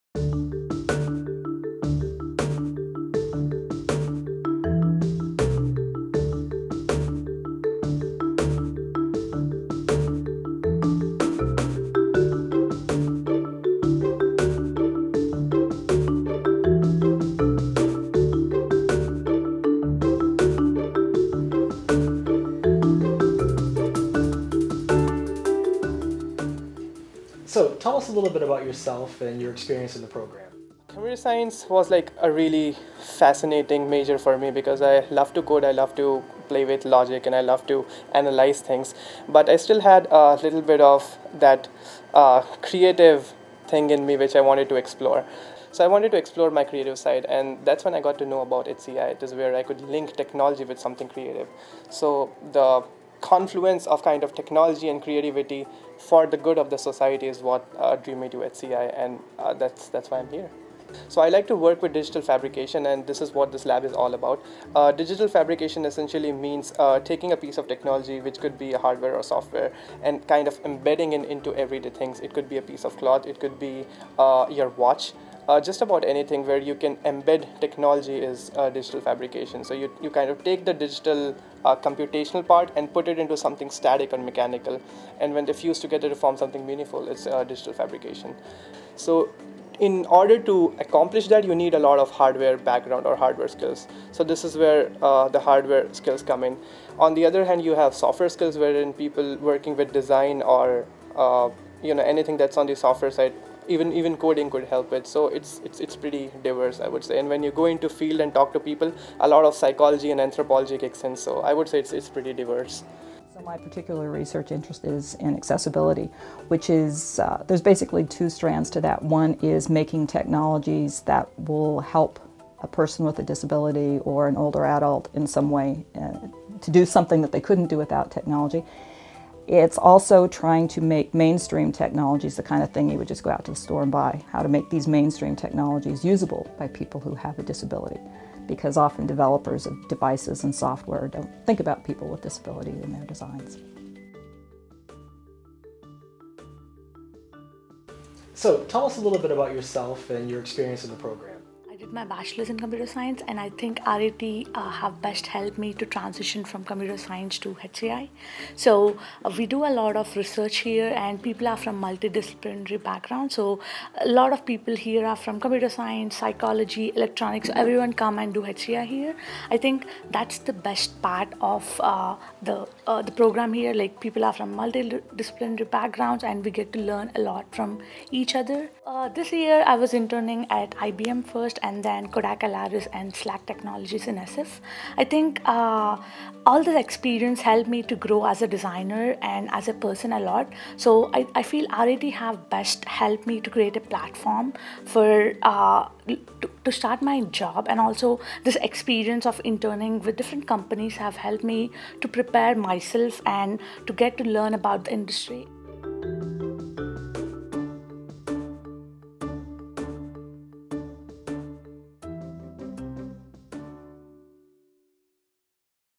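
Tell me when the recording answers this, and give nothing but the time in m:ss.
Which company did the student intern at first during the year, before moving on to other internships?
3:00.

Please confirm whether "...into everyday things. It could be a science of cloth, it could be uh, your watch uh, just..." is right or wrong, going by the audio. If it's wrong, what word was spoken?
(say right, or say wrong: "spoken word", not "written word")
wrong: "piece", not "science".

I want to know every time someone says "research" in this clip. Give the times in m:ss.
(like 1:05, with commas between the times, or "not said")
1:54, 2:40.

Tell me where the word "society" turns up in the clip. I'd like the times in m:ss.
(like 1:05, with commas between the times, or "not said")
0:56.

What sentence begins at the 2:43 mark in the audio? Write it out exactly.
So a lot of people here are from computer science, psychology, electronics.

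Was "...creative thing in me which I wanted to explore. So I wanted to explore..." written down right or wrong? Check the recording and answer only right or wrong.
right.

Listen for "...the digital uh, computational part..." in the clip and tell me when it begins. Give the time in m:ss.
1:20.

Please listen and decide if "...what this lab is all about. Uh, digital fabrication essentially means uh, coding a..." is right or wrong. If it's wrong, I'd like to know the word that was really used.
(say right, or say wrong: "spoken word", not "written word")
wrong: "taking", not "coding".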